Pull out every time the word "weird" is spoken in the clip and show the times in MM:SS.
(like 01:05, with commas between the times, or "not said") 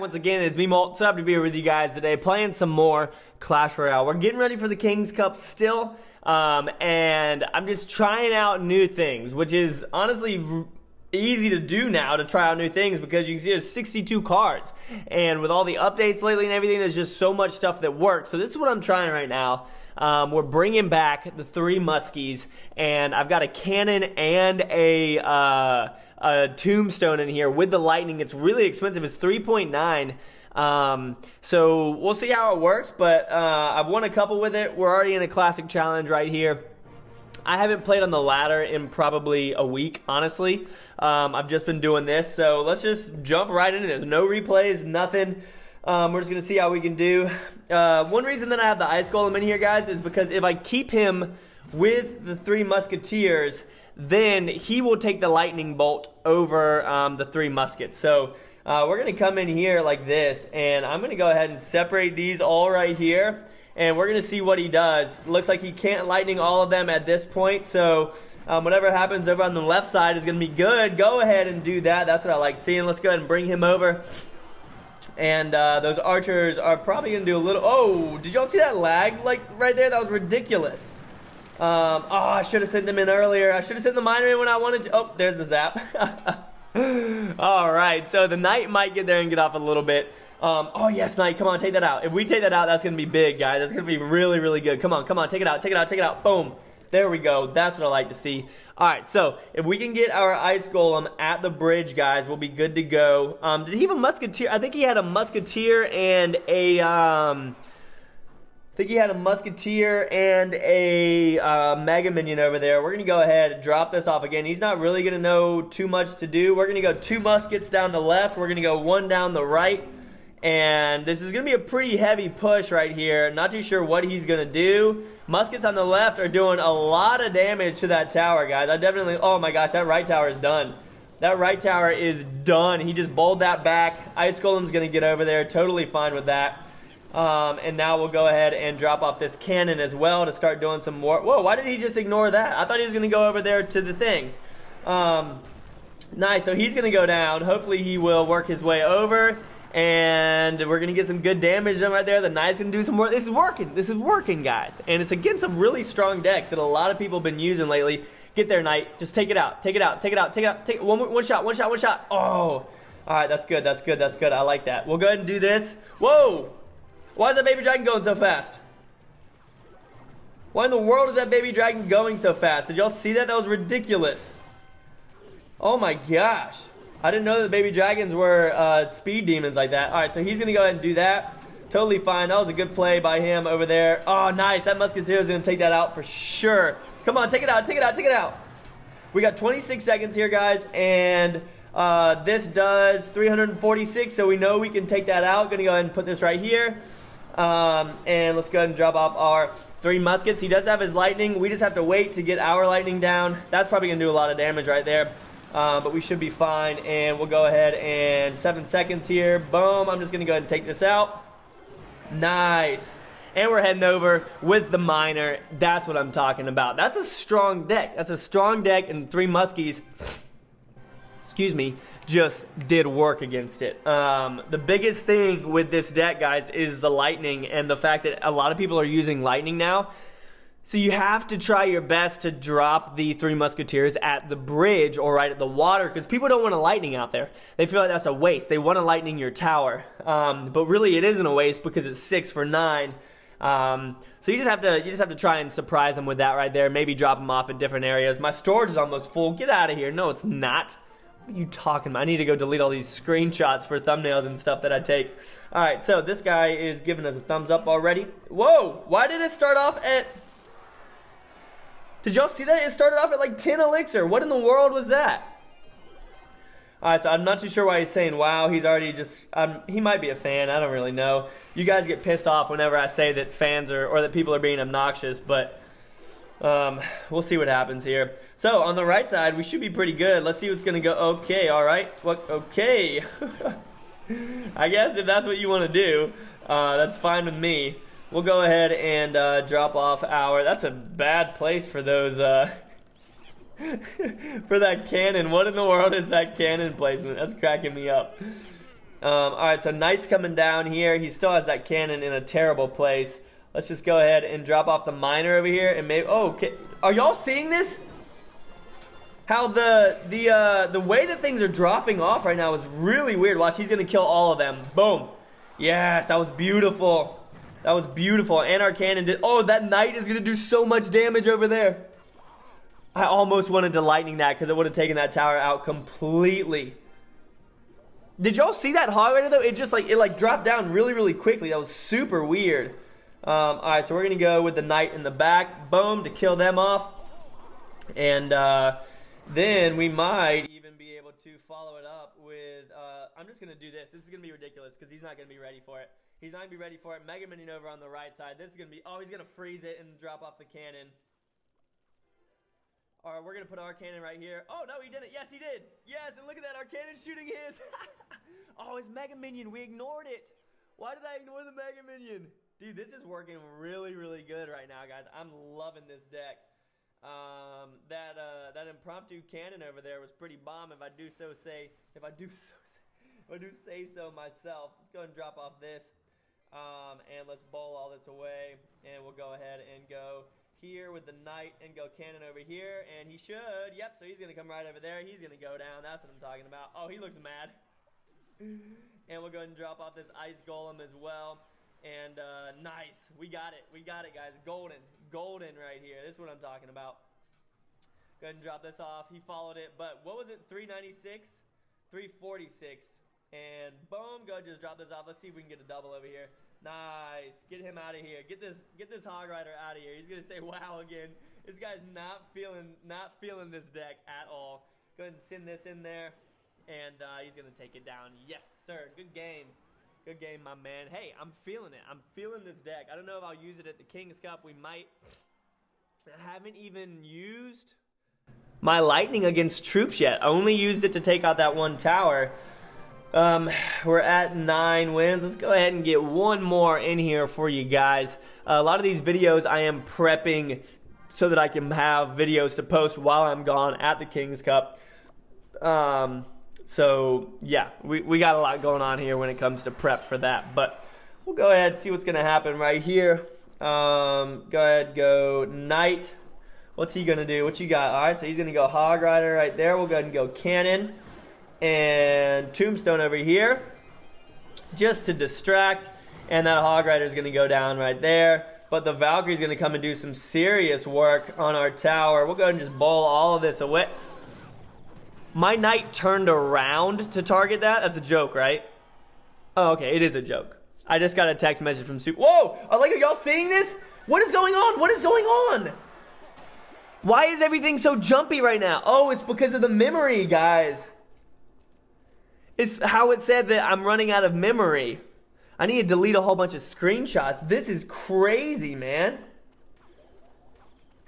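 05:13, 05:32.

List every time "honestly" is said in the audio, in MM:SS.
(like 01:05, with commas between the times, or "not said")
00:09, 00:40.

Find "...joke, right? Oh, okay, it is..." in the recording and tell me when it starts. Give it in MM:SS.
07:58.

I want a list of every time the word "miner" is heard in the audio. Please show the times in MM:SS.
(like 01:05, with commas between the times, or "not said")
01:24, 03:34, 05:04.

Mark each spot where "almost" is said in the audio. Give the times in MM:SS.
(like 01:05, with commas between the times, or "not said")
04:08, 05:23.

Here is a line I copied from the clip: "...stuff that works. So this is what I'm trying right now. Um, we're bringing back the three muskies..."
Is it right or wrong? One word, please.
right.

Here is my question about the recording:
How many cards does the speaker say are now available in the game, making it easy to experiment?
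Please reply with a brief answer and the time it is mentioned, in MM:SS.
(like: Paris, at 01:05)
62, at 00:13.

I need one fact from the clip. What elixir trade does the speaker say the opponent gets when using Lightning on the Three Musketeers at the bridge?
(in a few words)
6 for 9.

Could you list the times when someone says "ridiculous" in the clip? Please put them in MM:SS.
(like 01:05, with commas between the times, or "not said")
01:20, 02:53, 05:44.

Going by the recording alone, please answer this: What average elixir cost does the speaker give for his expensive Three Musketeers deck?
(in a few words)
3.9.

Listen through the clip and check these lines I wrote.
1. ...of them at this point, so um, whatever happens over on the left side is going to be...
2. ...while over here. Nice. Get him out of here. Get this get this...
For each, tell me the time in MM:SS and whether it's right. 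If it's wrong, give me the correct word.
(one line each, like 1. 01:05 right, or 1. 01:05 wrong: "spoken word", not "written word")
1. 01:06 right
2. 06:45 wrong: "double", not "while".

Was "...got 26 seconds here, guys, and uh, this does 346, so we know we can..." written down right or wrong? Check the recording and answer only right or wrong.
right.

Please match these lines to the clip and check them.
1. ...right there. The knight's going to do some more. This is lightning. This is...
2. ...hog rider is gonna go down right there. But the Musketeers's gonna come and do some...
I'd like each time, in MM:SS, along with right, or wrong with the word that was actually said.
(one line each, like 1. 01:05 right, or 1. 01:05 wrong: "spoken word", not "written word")
1. 02:31 wrong: "working", not "lightning"
2. 07:46 wrong: "Valkyrie", not "Musketeers".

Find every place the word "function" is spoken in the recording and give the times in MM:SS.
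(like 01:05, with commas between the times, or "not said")
not said.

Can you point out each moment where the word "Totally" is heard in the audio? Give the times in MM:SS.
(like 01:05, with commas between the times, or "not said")
02:15, 03:01.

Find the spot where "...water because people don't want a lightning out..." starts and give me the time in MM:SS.
03:55.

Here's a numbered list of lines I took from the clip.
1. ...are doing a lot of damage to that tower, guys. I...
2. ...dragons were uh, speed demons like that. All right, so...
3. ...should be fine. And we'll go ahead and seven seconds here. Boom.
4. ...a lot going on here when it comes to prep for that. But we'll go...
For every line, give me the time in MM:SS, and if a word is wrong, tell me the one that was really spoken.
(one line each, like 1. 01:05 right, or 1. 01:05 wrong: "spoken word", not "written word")
1. 02:06 right
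2. 02:57 right
3. 03:26 right
4. 07:28 right.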